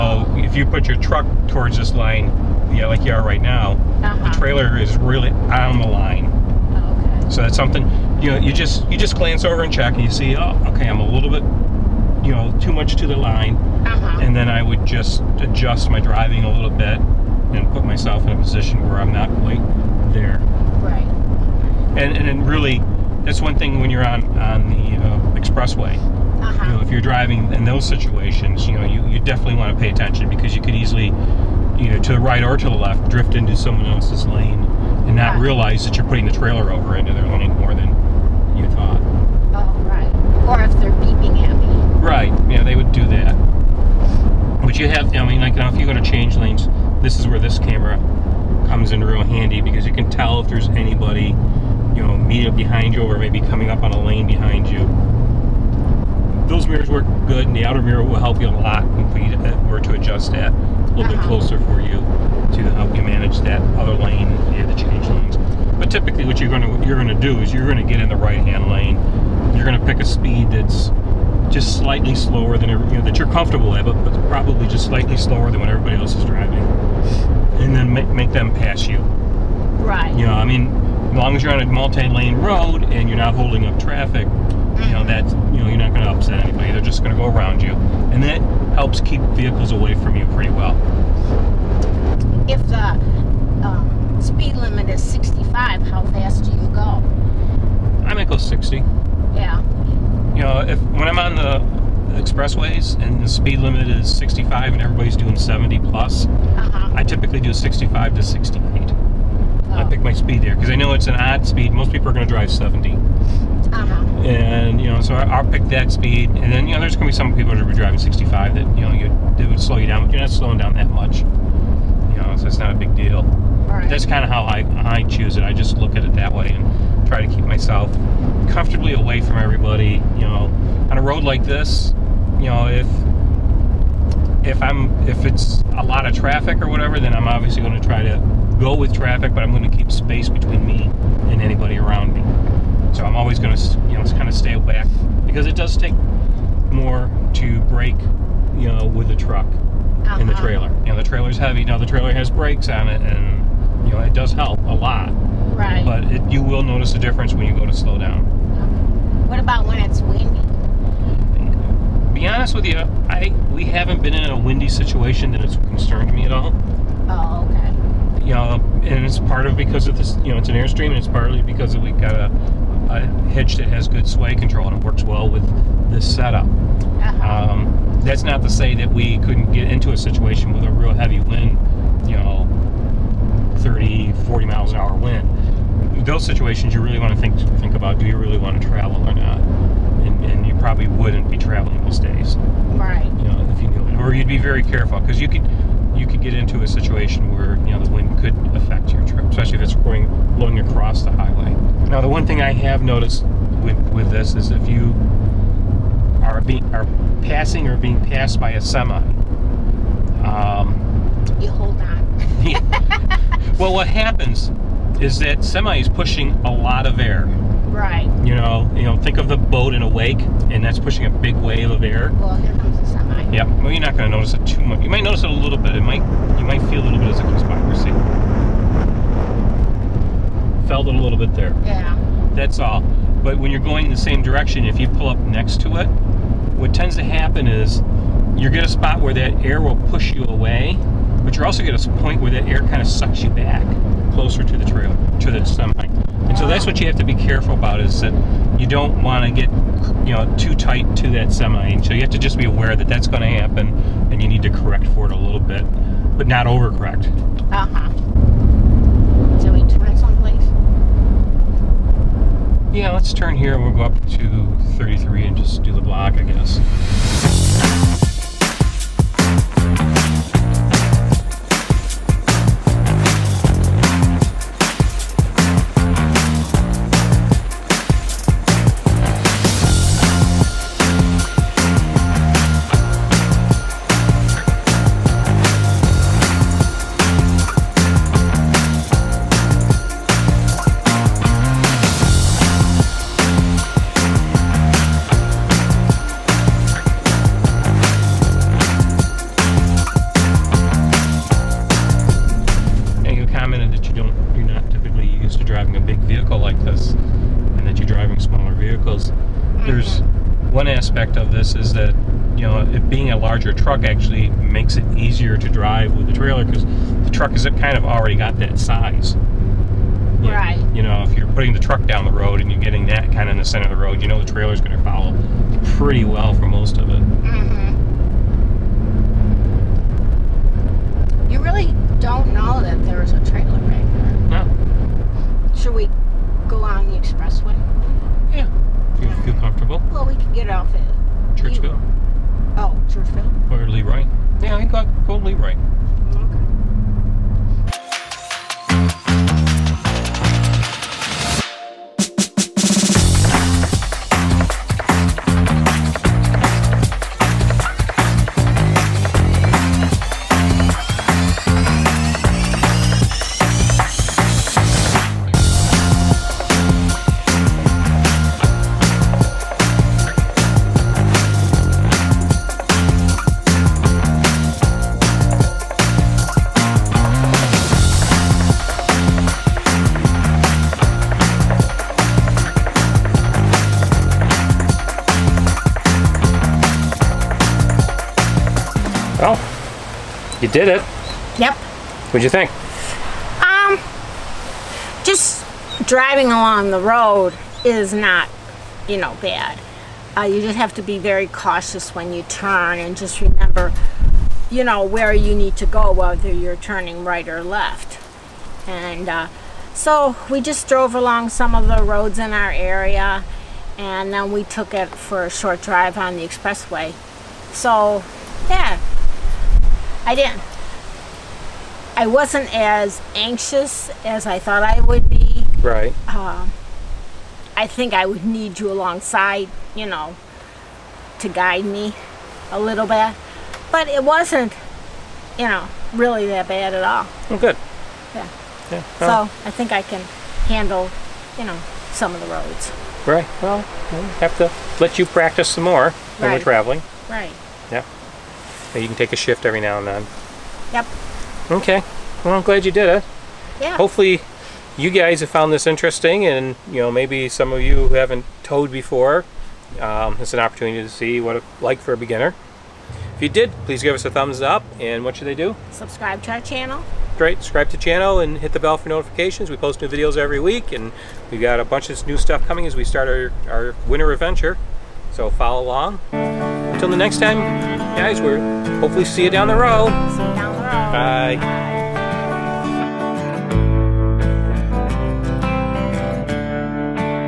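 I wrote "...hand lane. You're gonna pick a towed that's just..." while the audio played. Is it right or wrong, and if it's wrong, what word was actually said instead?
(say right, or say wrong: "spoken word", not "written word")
wrong: "speed", not "towed".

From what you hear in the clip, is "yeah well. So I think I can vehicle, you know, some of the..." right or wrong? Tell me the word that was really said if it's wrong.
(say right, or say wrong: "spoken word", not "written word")
wrong: "handle", not "vehicle".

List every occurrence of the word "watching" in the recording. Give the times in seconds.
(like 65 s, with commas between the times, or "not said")
not said.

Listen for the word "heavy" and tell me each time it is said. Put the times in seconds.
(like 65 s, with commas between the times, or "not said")
151 s, 180 s.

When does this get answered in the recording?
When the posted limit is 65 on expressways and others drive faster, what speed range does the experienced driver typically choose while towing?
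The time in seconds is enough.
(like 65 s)
107 s.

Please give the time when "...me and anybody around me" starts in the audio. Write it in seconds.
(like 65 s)
140 s.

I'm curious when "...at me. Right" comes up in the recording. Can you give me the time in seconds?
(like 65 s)
41 s.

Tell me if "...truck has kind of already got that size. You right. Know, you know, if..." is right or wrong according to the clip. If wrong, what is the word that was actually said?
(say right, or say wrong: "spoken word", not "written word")
right.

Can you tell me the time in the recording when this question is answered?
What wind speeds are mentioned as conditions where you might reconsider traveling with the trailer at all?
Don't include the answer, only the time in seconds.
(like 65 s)
183 s.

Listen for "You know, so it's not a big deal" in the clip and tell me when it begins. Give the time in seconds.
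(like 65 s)
121 s.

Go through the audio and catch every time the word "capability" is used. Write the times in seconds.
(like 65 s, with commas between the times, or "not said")
not said.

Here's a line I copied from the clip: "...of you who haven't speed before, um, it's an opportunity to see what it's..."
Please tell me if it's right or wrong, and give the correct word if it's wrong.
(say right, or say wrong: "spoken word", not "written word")
wrong: "towed", not "speed".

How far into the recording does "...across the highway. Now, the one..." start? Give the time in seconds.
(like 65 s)
200 s.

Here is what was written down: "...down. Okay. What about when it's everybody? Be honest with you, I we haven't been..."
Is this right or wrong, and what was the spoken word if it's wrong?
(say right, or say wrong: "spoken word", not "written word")
wrong: "windy", not "everybody".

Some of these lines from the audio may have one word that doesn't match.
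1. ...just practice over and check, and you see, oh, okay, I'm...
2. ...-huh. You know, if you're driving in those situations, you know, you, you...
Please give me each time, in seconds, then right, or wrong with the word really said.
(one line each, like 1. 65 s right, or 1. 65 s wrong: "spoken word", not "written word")
1. 8 s wrong: "glance", not "practice"
2. 26 s right.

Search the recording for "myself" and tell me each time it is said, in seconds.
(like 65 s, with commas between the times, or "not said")
17 s, 127 s.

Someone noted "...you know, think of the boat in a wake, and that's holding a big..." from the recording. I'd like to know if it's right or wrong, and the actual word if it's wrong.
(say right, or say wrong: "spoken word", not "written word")
wrong: "pushing", not "holding".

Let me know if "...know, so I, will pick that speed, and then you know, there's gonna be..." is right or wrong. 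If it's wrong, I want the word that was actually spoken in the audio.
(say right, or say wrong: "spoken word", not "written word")
right.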